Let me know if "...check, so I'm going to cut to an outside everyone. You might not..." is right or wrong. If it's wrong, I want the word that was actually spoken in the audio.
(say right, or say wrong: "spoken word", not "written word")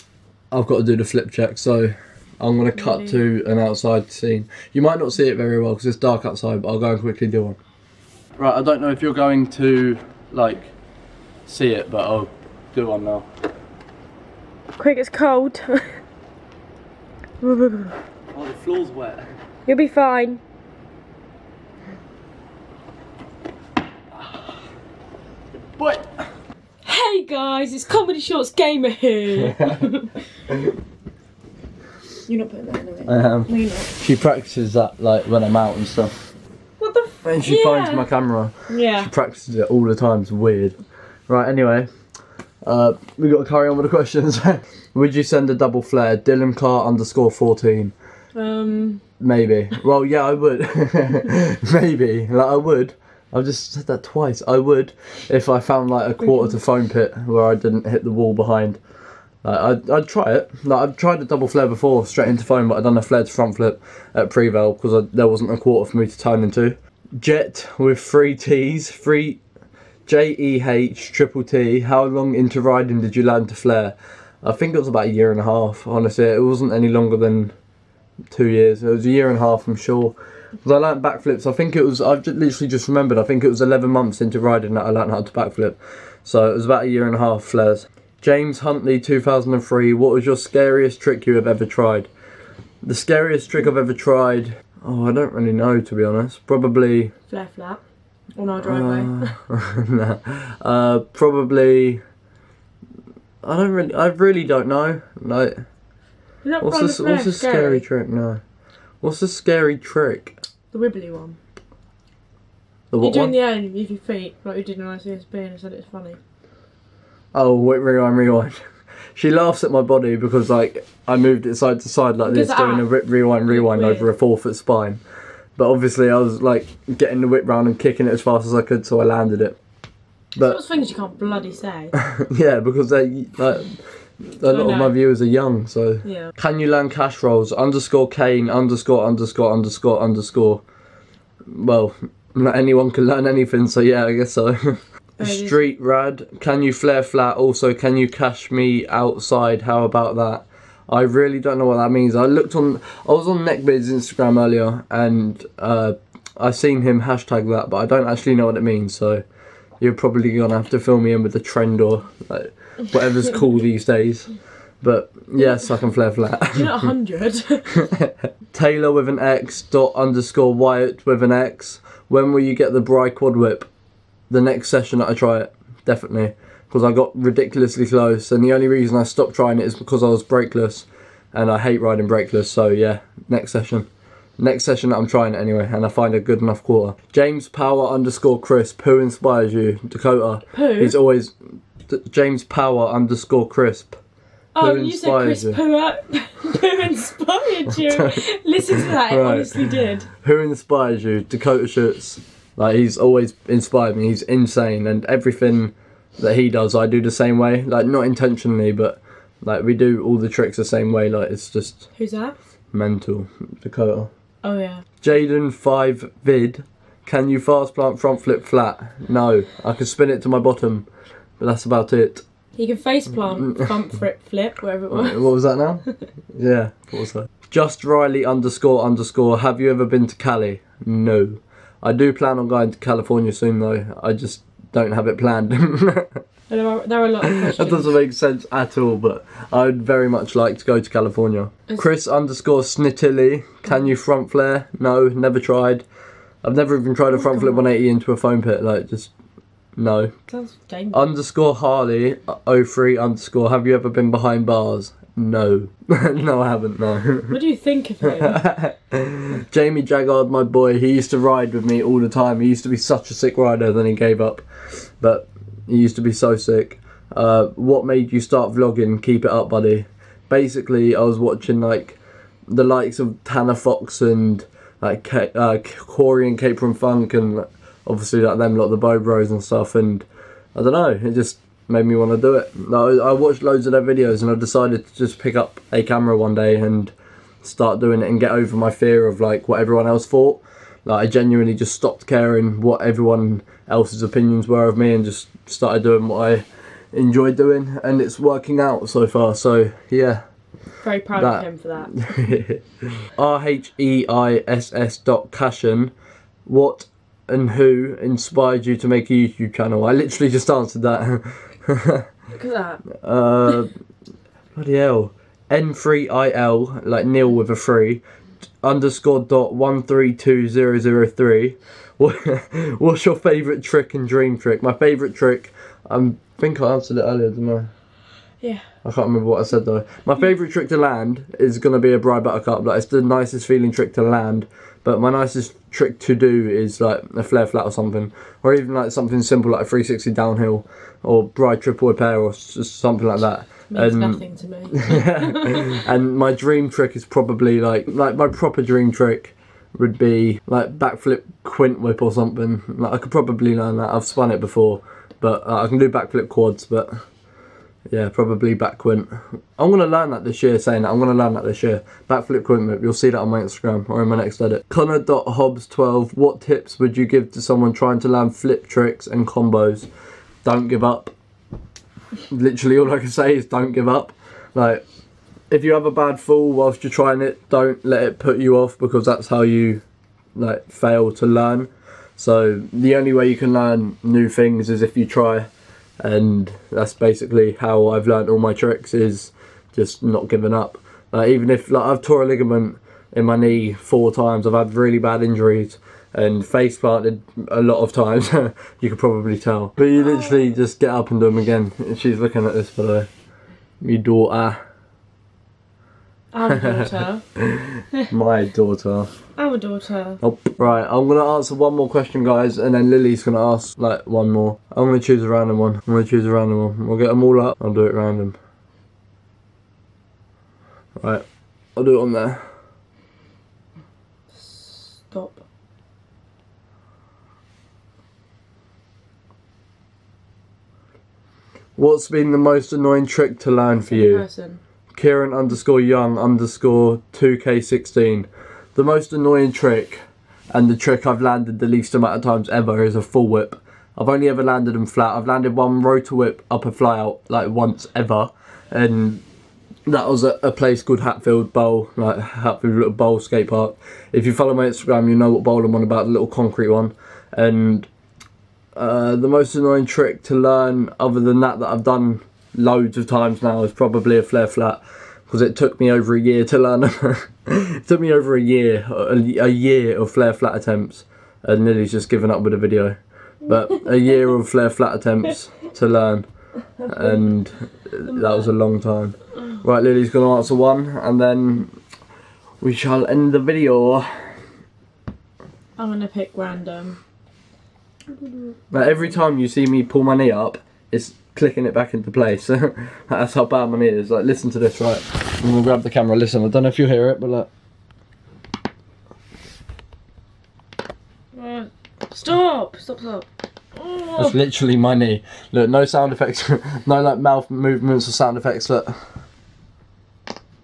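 wrong: "scene", not "everyone".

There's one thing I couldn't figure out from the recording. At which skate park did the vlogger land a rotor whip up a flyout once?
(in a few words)
Hatfield Bowl.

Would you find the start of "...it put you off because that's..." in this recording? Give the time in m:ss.
6:18.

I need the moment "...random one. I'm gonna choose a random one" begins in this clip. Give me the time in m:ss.
6:55.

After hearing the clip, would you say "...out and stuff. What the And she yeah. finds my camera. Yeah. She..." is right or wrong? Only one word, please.
right.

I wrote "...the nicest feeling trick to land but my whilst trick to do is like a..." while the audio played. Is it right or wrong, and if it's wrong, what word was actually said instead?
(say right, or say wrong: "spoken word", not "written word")
wrong: "nicest", not "whilst".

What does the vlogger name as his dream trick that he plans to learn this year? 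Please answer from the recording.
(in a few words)
backflip quint whip.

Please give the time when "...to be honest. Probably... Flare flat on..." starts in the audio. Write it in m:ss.
1:35.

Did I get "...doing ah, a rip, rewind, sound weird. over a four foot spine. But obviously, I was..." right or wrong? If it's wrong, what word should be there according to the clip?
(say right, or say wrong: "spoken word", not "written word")
wrong: "rewind", not "sound".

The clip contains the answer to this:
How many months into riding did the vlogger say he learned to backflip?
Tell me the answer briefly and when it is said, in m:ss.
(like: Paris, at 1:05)
11, at 1:23.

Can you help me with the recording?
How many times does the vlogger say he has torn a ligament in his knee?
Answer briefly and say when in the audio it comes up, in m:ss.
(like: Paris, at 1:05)
4, at 6:33.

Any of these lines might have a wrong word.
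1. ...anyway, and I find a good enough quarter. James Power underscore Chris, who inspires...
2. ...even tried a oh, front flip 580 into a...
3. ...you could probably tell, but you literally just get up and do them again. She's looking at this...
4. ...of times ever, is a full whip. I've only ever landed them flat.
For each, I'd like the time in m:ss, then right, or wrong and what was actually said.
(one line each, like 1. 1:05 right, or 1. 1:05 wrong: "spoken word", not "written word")
1. 3:05 right
2. 4:06 wrong: "180", not "580"
3. 6:38 right
4. 7:22 right.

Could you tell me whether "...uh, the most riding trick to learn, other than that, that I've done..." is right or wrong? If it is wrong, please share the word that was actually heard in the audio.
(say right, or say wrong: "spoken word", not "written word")
wrong: "annoying", not "riding".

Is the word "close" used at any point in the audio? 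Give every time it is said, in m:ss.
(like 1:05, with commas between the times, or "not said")
2:57.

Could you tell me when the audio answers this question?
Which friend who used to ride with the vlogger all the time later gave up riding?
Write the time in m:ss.
4:19.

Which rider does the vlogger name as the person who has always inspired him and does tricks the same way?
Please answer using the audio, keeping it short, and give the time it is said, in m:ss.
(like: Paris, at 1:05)
Dakota Schutz, at 3:21.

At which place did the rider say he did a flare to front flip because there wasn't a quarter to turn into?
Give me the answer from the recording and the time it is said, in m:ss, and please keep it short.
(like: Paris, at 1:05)
Prevail, at 1:04.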